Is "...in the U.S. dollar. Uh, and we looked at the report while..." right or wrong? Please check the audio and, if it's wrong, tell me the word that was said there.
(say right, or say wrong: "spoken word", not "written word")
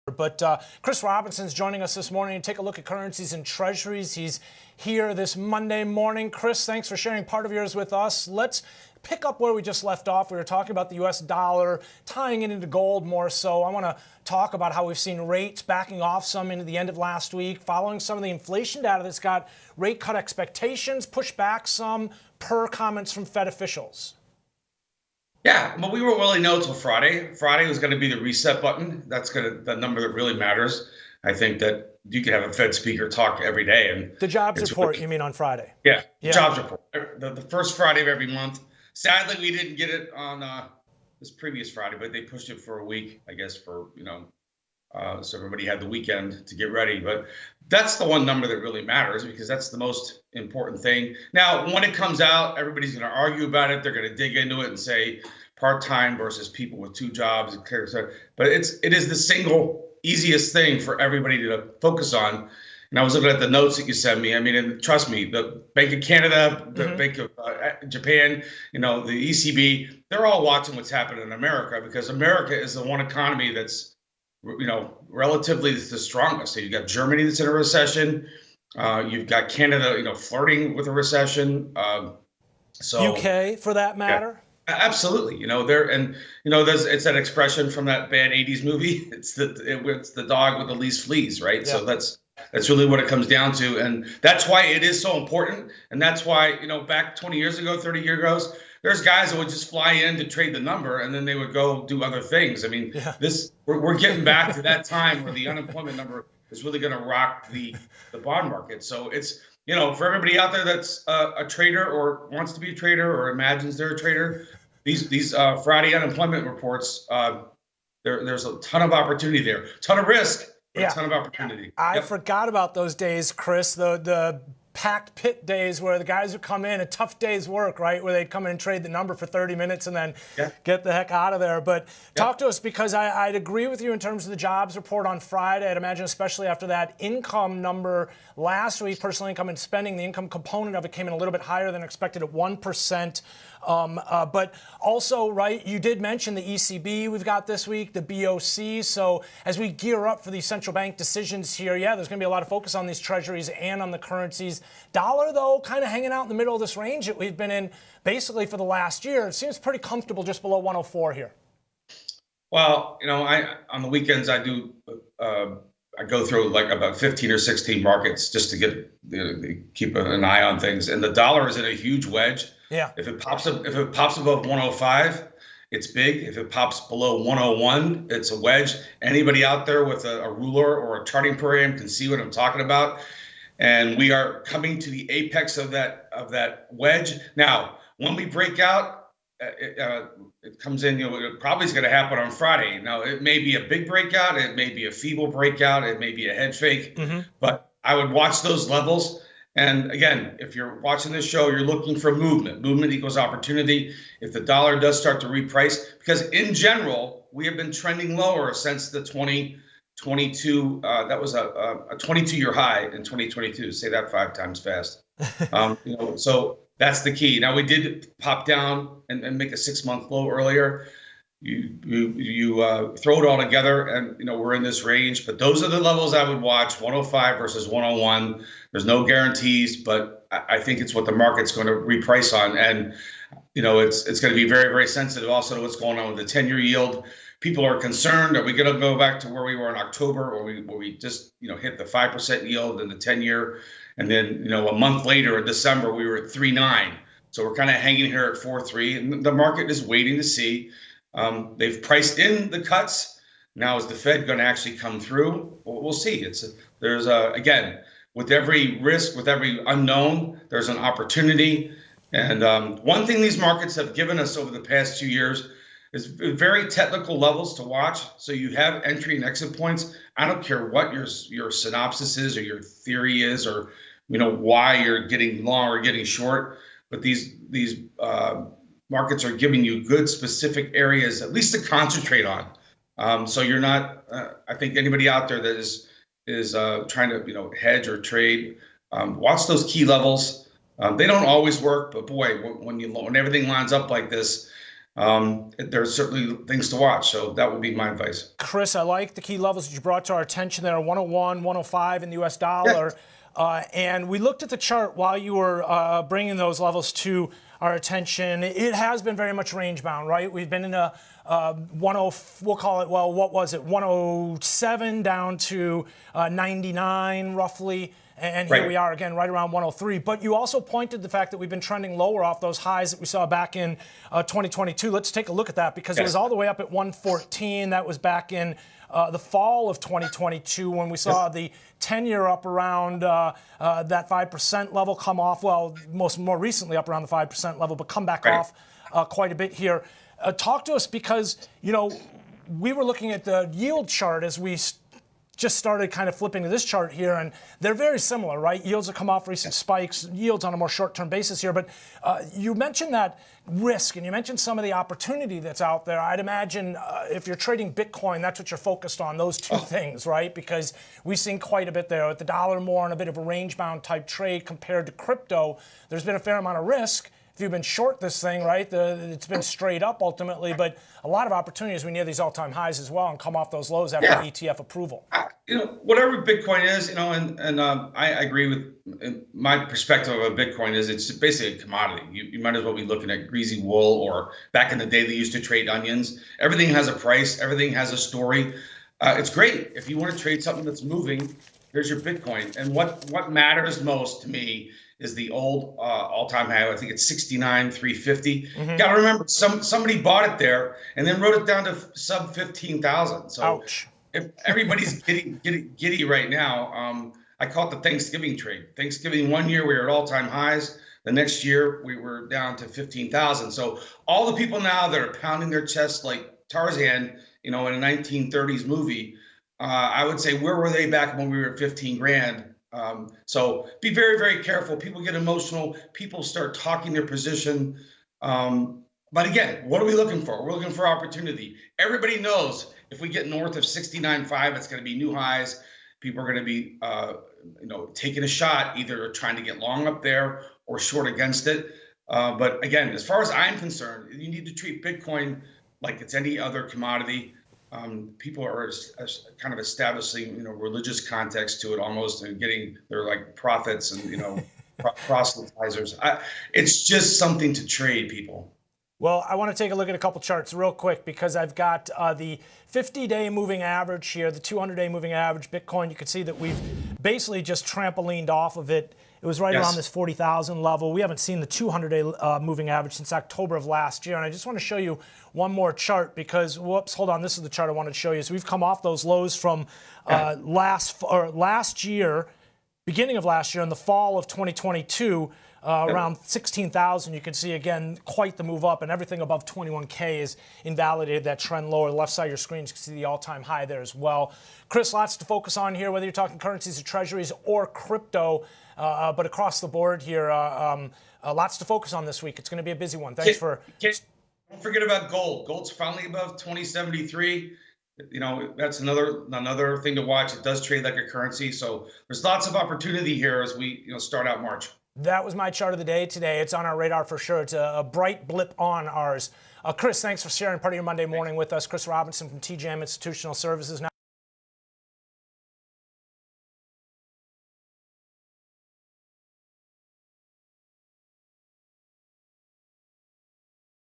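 wrong: "chart", not "report".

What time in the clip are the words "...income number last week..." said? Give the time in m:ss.
2:16.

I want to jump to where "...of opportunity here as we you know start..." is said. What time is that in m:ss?
8:32.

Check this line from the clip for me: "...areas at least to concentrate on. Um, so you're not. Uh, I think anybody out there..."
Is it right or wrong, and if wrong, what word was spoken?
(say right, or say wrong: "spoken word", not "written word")
right.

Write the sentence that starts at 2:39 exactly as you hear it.
It seems pretty comfortable just below 104 here.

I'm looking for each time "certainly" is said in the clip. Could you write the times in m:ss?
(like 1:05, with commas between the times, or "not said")
4:55.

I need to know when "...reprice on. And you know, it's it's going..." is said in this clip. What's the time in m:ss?
3:51.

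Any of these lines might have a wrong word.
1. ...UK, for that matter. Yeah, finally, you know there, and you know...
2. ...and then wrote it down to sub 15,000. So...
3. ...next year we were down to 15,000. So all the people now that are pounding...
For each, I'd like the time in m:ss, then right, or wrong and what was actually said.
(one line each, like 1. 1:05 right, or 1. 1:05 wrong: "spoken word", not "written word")
1. 1:23 wrong: "absolutely", not "finally"
2. 6:40 right
3. 6:51 right.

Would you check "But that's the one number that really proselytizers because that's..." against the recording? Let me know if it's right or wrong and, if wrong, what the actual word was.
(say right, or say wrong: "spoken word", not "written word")
wrong: "matters", not "proselytizers".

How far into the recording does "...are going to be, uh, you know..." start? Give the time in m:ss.
7:16.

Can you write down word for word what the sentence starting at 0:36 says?
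Er, the, the, first Friday of every month.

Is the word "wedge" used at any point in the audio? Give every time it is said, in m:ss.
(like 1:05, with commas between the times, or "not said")
2:52, 2:58, 3:06.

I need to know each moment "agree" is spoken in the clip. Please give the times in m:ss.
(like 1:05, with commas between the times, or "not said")
2:13, 6:18.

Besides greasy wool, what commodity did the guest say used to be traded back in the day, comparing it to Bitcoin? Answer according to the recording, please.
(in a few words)
Onions.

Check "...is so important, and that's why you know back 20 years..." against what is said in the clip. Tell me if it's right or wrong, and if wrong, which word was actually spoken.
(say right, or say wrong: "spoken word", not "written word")
right.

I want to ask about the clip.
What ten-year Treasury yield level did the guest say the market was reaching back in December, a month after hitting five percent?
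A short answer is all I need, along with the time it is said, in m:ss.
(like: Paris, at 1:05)
3.9, at 4:06.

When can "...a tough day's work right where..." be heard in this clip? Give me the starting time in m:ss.
2:06.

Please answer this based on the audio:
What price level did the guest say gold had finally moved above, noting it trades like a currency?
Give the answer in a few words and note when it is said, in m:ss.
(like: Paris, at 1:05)
2073, at 8:26.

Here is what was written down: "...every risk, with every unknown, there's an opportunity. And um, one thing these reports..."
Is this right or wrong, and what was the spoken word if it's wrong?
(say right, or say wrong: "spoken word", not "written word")
wrong: "markets", not "reports".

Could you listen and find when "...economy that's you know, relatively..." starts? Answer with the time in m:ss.
1:12.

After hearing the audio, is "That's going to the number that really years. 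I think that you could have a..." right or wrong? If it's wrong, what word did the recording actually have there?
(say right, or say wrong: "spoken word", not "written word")
wrong: "matters", not "years".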